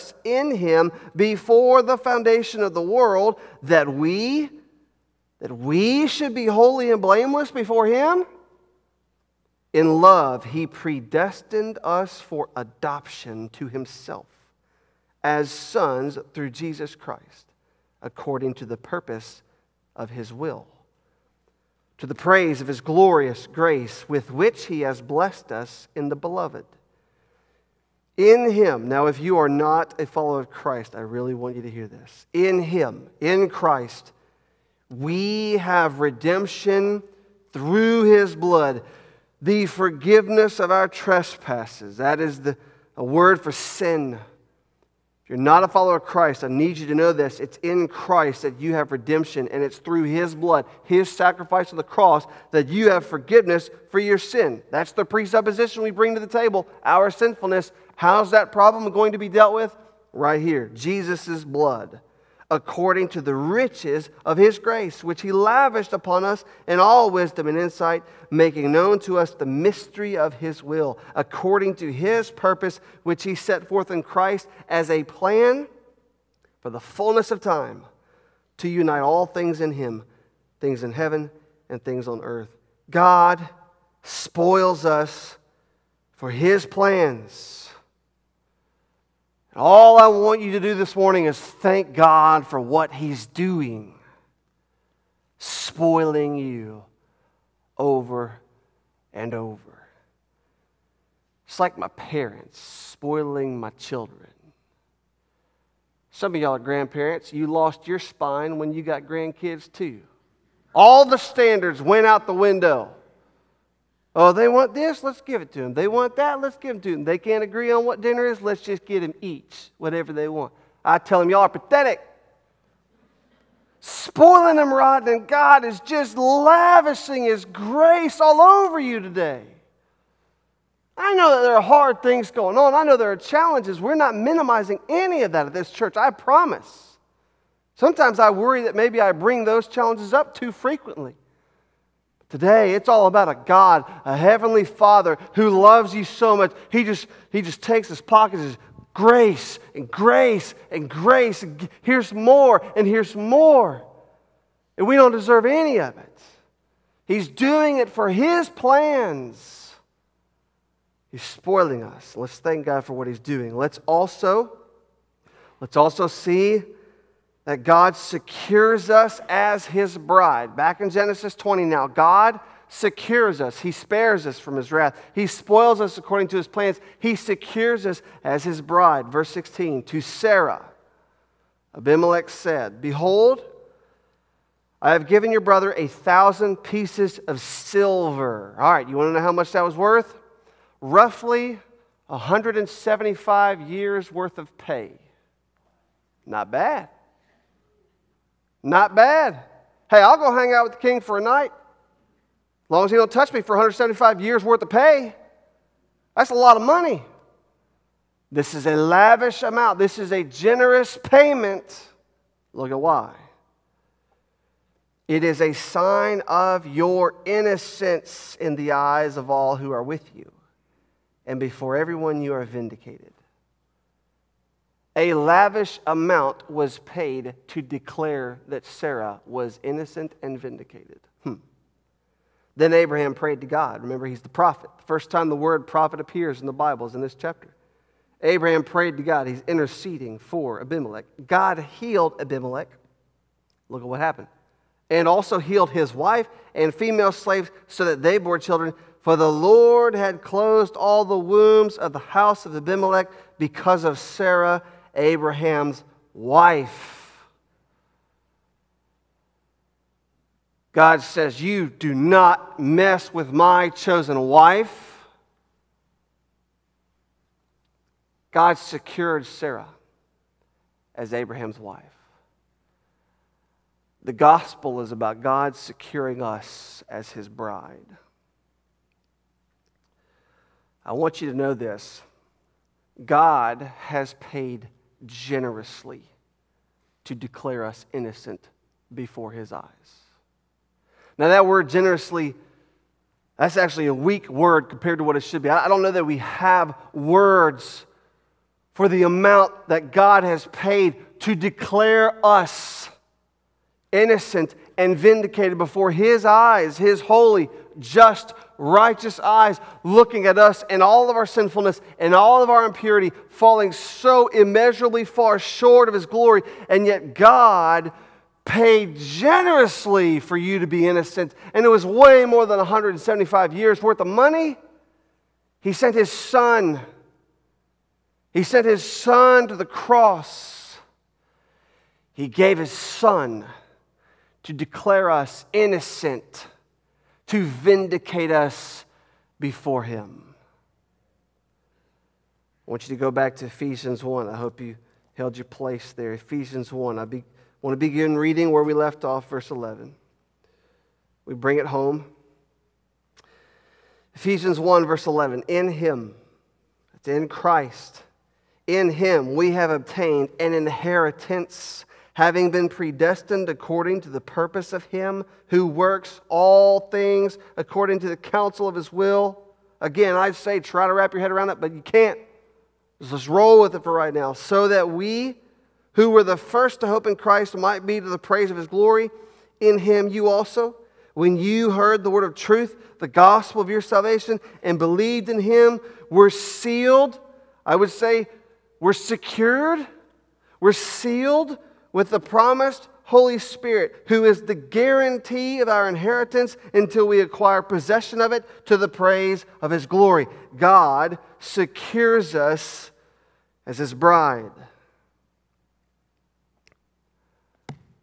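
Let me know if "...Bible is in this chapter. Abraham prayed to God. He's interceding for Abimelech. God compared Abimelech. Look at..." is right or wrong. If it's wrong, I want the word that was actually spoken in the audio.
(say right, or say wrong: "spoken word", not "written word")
wrong: "healed", not "compared".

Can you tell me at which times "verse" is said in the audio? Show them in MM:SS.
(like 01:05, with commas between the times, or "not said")
02:59, 05:49, 05:54.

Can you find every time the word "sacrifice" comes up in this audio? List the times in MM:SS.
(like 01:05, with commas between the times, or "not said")
00:51.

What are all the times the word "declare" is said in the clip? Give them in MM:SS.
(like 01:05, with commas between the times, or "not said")
03:47, 04:47, 05:01, 05:34.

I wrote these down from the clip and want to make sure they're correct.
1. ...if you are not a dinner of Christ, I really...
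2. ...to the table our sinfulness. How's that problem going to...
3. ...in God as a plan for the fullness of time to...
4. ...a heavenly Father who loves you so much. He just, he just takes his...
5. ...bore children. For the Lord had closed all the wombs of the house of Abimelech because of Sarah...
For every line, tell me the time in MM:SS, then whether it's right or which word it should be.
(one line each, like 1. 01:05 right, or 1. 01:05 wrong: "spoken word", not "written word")
1. 00:29 wrong: "follower", not "dinner"
2. 00:56 right
3. 01:13 wrong: "Christ", not "God"
4. 02:24 right
5. 04:08 right.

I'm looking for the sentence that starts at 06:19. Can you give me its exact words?
In Him, you also, when you heard the word of truth, the gospel of your salvation, and believed in Him, were sealed.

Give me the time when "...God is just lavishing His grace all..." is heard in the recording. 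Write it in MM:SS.
02:05.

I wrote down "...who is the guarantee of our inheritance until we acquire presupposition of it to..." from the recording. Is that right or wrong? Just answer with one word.
wrong.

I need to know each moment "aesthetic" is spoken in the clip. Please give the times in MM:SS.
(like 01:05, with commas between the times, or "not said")
not said.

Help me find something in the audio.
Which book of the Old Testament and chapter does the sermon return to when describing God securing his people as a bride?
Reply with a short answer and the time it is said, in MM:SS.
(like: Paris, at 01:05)
Genesis 20, at 02:50.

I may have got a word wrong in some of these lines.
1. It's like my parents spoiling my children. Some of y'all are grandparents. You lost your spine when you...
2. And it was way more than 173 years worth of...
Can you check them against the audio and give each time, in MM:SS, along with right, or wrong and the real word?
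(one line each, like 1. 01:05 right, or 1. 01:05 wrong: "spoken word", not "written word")
1. 01:41 right
2. 05:21 wrong: "175", not "173".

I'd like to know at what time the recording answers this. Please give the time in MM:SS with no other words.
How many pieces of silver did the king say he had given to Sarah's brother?
03:05.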